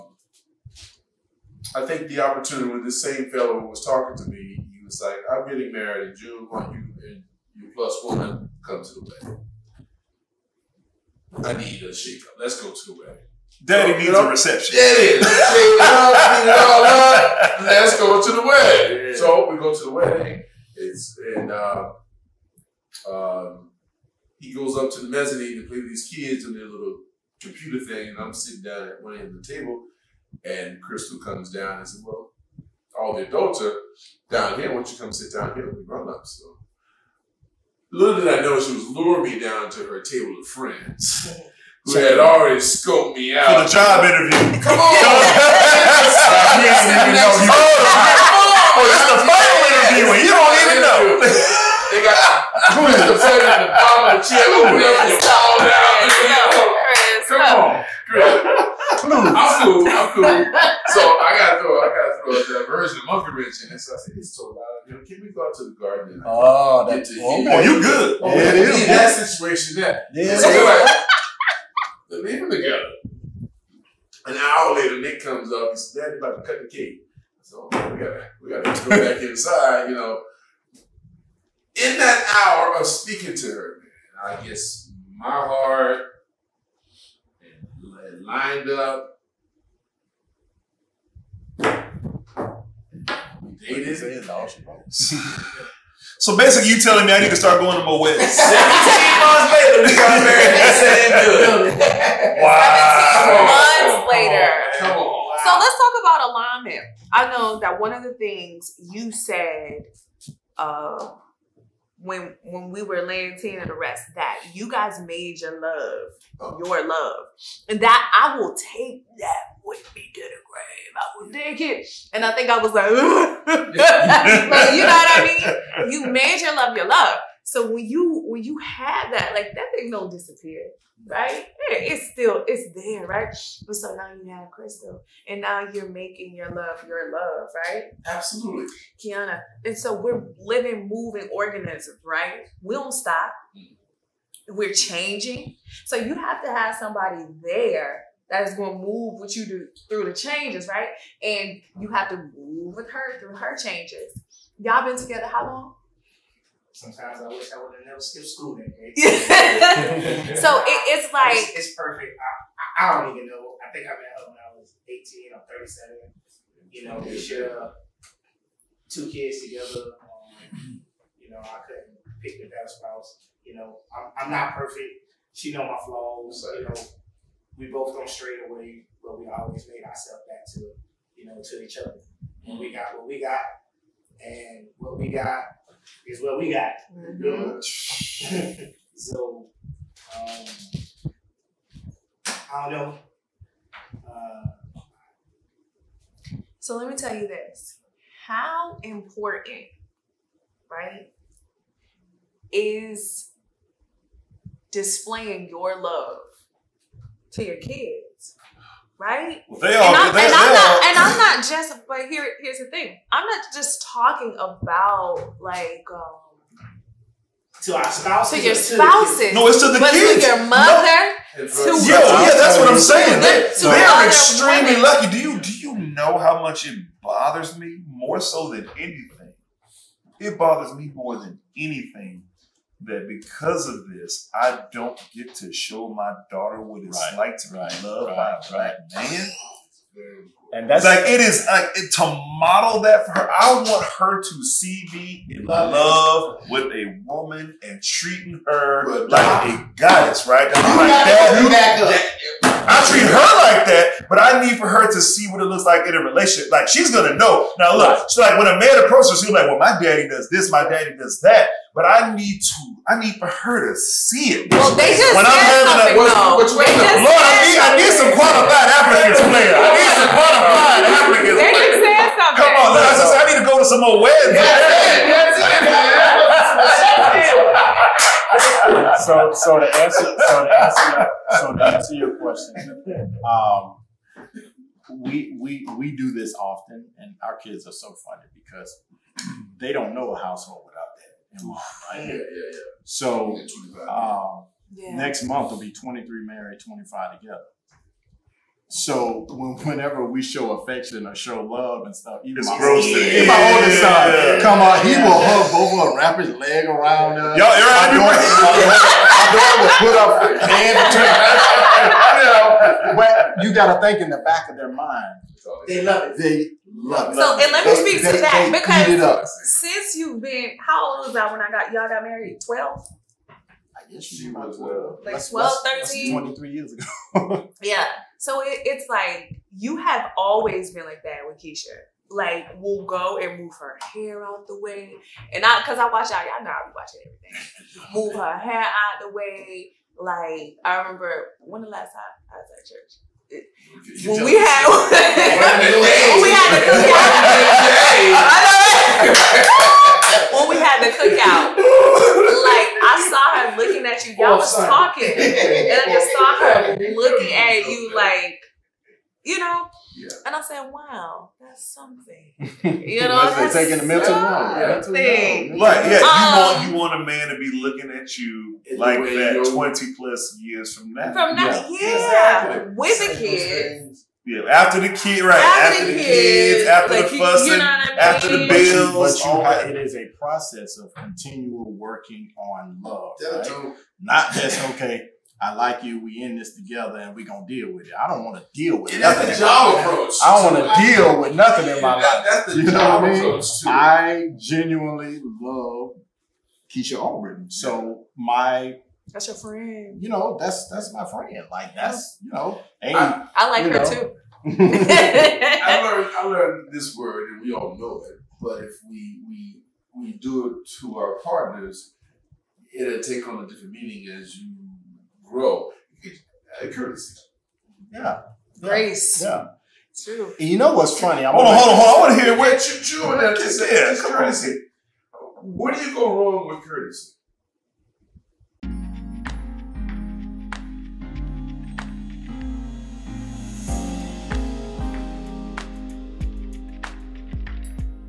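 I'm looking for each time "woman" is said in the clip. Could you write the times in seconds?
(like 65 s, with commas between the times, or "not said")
8 s, 247 s.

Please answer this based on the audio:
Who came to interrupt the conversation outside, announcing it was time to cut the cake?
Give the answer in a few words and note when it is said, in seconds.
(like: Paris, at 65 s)
Nick, at 75 s.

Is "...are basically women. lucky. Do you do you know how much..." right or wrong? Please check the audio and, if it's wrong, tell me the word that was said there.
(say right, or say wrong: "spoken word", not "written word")
wrong: "extremely", not "basically".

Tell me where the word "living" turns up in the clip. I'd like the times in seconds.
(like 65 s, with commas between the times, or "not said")
140 s.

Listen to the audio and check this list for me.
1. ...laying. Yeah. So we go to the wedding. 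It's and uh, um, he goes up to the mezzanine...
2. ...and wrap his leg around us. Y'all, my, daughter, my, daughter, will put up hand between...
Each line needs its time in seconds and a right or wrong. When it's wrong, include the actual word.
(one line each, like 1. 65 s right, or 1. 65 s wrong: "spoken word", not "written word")
1. 18 s wrong: "wedding", not "laying"
2. 305 s right.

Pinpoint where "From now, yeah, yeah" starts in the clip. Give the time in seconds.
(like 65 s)
371 s.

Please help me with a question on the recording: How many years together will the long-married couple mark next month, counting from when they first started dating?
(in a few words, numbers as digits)
25.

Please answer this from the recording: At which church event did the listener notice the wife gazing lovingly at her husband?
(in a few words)
the cookout.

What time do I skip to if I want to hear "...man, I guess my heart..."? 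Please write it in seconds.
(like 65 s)
84 s.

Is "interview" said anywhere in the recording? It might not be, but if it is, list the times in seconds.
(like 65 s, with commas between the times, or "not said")
44 s, 49 s.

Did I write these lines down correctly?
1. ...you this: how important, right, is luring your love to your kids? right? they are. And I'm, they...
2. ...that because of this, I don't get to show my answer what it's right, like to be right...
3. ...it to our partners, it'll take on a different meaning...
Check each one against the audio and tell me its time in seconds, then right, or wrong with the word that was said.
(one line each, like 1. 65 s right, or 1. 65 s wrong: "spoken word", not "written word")
1. 197 s wrong: "displaying", not "luring"
2. 232 s wrong: "daughter", not "answer"
3. 410 s right.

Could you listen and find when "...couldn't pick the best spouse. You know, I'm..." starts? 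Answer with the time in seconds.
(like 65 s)
171 s.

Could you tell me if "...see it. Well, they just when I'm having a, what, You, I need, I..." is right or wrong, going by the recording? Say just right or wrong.
wrong.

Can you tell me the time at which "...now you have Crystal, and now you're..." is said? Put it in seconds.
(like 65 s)
133 s.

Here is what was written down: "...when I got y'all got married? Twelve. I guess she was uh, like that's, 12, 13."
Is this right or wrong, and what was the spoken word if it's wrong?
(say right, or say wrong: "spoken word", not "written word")
right.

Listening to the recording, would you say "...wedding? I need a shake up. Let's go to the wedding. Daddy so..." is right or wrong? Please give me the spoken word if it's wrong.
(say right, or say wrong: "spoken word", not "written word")
right.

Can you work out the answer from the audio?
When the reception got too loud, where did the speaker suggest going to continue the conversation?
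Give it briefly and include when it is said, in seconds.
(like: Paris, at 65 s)
the garden, at 65 s.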